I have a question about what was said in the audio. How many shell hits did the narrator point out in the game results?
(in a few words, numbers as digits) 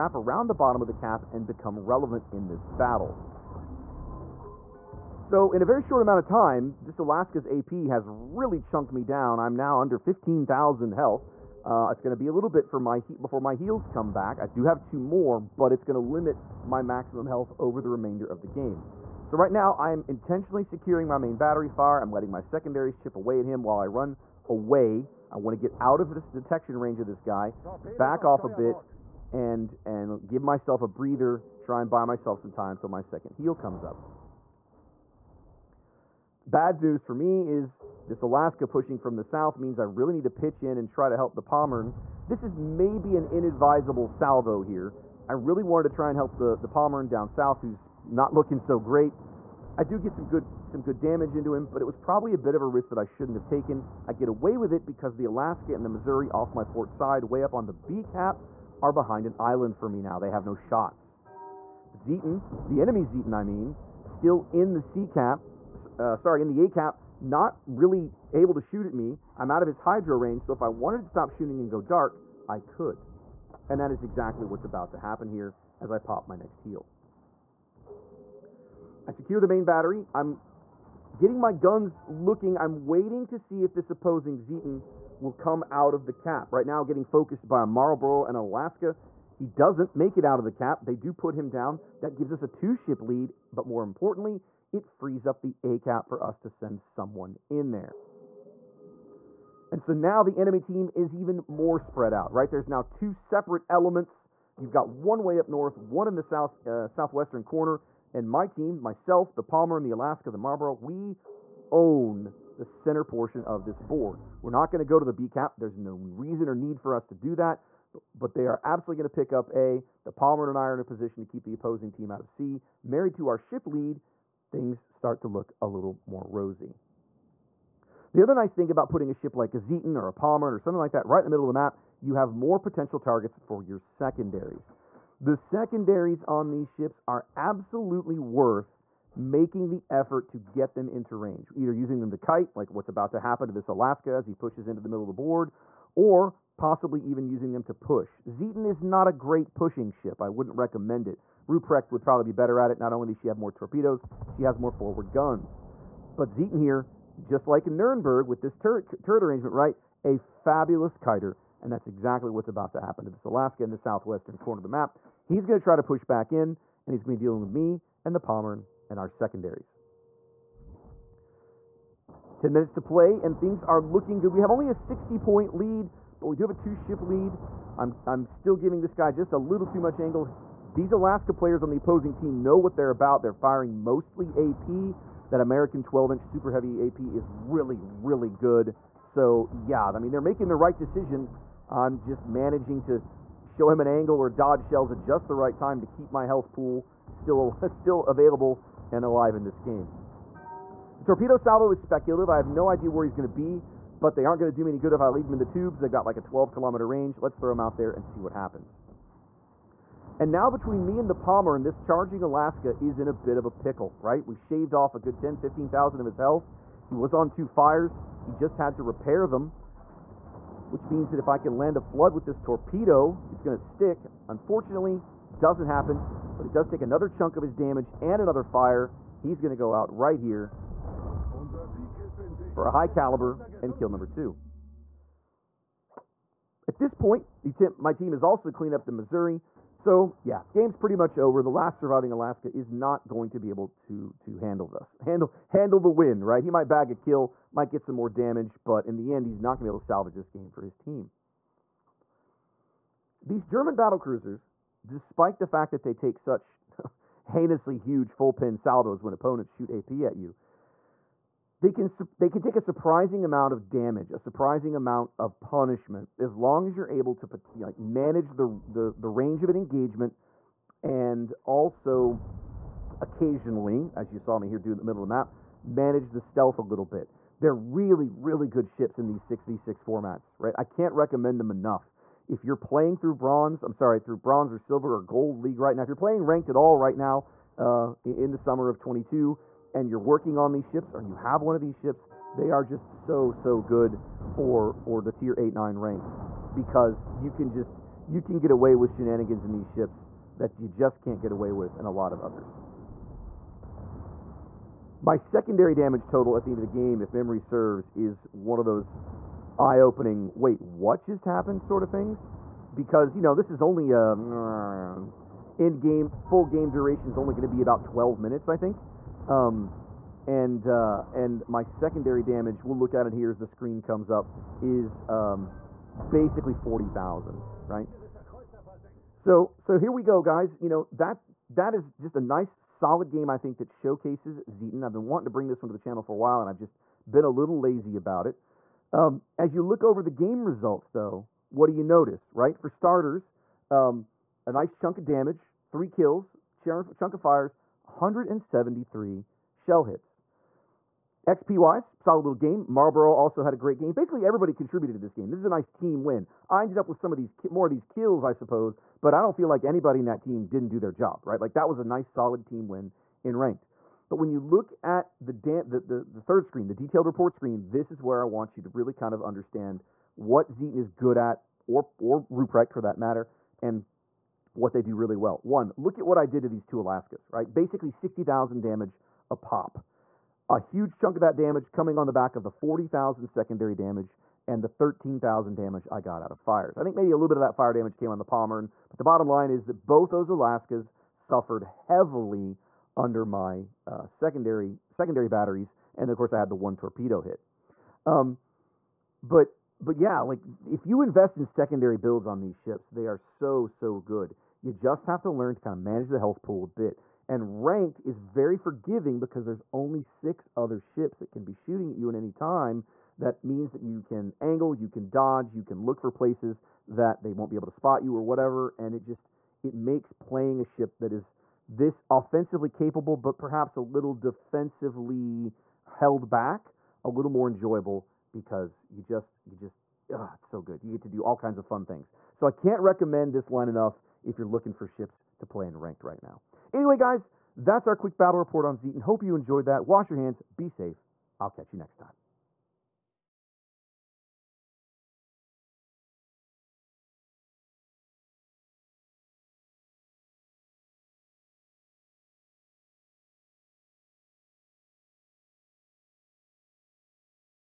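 173.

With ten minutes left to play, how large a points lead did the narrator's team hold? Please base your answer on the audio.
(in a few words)
60 points.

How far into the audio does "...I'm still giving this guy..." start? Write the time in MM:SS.
02:58.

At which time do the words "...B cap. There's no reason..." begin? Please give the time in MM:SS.
01:55.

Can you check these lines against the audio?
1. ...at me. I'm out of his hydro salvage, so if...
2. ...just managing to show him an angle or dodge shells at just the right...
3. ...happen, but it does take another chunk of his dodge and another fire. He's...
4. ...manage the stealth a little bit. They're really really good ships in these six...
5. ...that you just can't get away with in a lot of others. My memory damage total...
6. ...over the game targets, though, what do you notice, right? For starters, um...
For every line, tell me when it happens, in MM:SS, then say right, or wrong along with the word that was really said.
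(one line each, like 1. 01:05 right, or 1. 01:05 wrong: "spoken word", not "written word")
1. 01:08 wrong: "range", not "salvage"
2. 03:11 right
3. 03:45 wrong: "damage", not "dodge"
4. 04:35 right
5. 05:00 wrong: "secondary", not "memory"
6. 05:39 wrong: "results", not "targets".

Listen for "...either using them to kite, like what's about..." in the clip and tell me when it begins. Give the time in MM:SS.
02:21.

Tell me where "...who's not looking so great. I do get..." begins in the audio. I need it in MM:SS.
00:47.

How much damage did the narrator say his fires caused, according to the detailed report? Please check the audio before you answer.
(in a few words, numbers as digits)
13,000.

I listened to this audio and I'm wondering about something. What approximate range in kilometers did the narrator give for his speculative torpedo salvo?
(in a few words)
12 kilometers.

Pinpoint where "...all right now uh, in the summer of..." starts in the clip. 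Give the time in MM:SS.
04:46.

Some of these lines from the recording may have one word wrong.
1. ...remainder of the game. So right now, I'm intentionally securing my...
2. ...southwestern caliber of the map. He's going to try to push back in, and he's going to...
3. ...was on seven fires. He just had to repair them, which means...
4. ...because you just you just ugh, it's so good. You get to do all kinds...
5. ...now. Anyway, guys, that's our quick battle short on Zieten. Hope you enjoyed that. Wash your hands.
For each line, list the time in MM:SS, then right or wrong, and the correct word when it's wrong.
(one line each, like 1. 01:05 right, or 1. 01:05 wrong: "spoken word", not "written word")
1. 00:17 right
2. 02:43 wrong: "corner", not "caliber"
3. 03:36 wrong: "two", not "seven"
4. 07:08 right
5. 07:16 wrong: "report", not "short".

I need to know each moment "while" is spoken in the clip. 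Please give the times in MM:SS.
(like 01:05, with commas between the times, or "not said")
00:23, 05:36.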